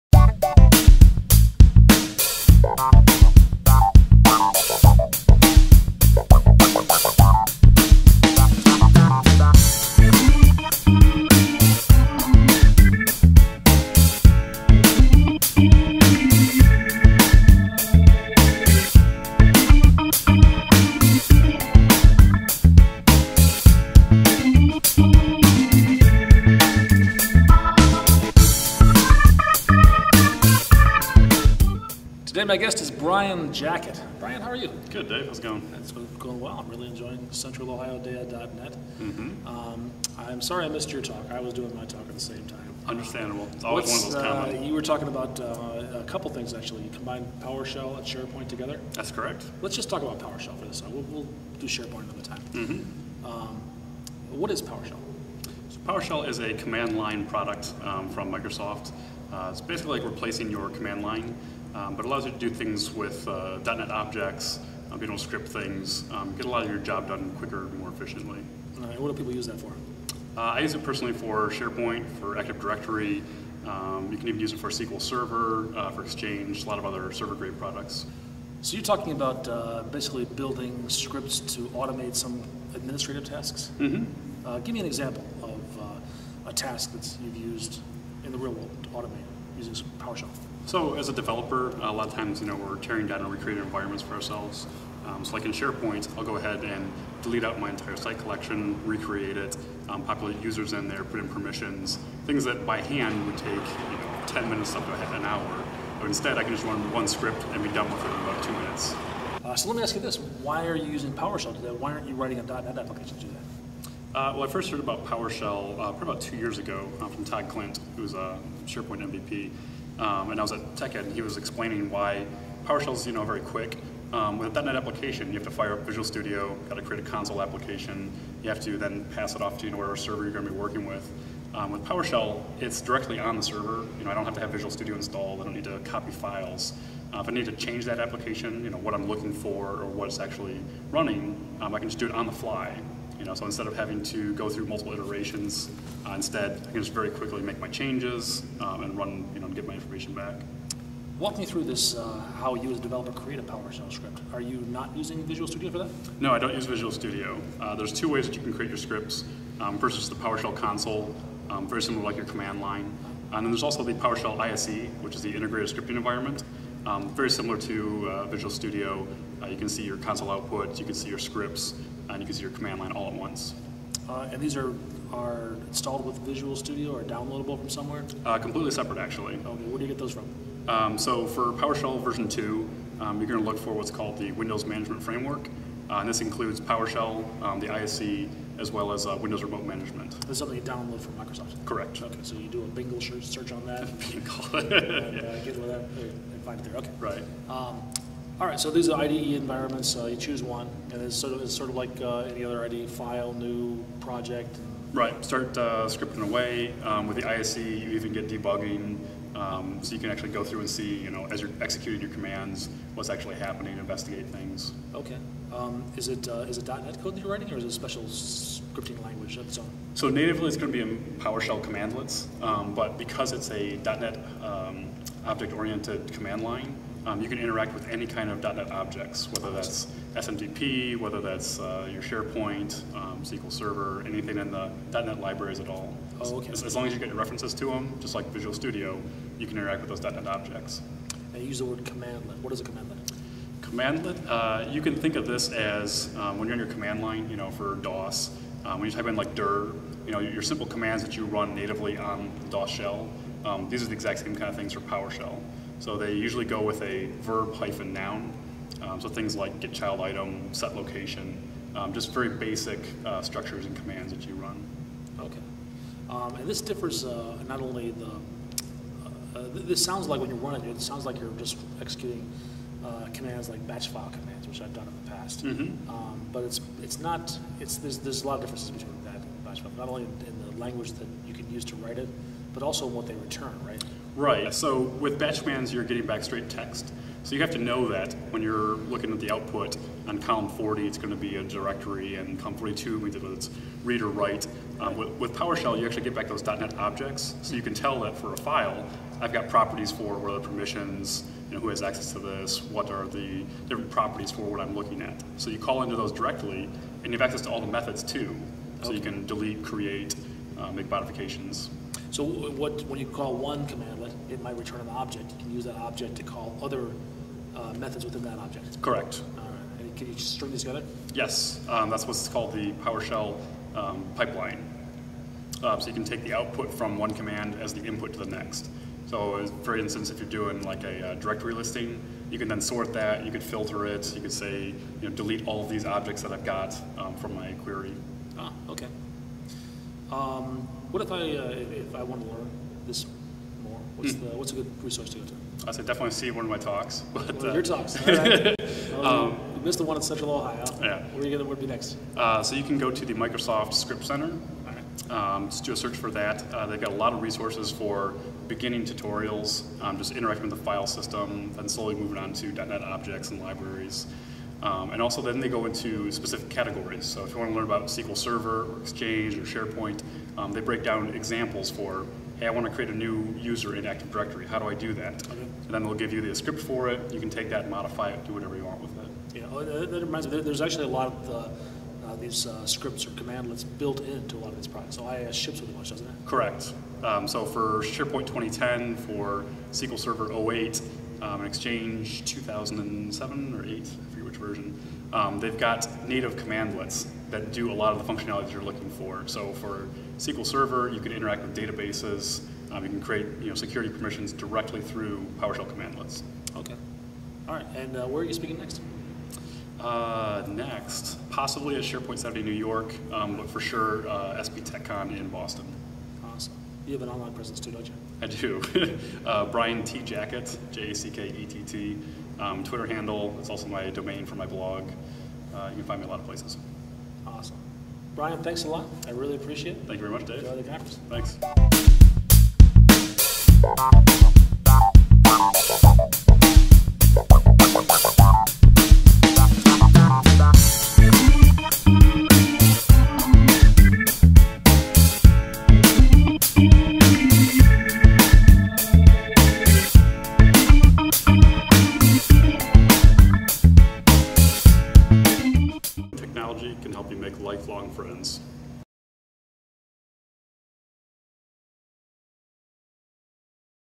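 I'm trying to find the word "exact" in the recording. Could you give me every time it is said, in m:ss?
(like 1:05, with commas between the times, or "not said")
4:13.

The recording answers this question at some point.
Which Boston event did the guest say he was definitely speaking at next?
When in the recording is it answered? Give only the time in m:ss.
6:54.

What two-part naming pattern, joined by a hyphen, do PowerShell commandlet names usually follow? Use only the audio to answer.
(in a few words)
verb hyphen noun.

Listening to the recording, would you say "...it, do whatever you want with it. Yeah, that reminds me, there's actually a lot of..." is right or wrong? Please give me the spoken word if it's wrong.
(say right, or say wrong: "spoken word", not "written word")
right.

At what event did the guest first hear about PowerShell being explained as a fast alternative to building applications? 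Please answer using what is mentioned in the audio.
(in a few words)
TechEd.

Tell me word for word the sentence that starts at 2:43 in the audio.
And then there's also the PowerShell ISE, which is the integrated scripting environment.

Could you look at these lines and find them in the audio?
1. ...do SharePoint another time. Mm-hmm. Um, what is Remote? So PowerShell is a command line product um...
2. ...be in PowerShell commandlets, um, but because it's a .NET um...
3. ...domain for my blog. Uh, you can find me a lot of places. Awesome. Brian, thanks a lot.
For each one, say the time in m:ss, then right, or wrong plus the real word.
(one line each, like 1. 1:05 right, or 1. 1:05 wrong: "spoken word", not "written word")
1. 0:51 wrong: "PowerShell", not "Remote"
2. 3:40 right
3. 7:03 right.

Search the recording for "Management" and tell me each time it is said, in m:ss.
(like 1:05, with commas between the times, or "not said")
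3:04, 3:09.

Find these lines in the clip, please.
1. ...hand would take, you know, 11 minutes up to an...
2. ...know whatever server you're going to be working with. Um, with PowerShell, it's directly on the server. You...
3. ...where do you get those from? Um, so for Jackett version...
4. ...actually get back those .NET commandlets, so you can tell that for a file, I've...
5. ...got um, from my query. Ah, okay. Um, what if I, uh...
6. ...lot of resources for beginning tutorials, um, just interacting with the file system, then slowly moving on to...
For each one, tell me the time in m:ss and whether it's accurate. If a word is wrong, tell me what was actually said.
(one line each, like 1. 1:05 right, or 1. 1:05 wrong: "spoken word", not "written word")
1. 1:42 wrong: "10", not "11"
2. 2:09 right
3. 2:59 wrong: "PowerShell", not "Jackett"
4. 4:55 wrong: "objects", not "commandlets"
5. 5:36 right
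6. 5:56 right.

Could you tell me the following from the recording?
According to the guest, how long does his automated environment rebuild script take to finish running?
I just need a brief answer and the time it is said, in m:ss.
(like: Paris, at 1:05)
2 minutes, at 1:48.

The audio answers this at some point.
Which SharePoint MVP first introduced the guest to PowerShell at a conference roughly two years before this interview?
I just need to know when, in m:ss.
1:57.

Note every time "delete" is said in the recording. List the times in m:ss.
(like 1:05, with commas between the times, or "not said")
1:37, 5:09, 5:35.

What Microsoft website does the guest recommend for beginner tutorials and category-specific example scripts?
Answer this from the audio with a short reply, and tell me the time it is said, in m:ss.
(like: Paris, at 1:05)
Microsoft Script Center, at 5:53.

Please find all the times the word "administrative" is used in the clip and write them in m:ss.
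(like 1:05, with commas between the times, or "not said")
1:22.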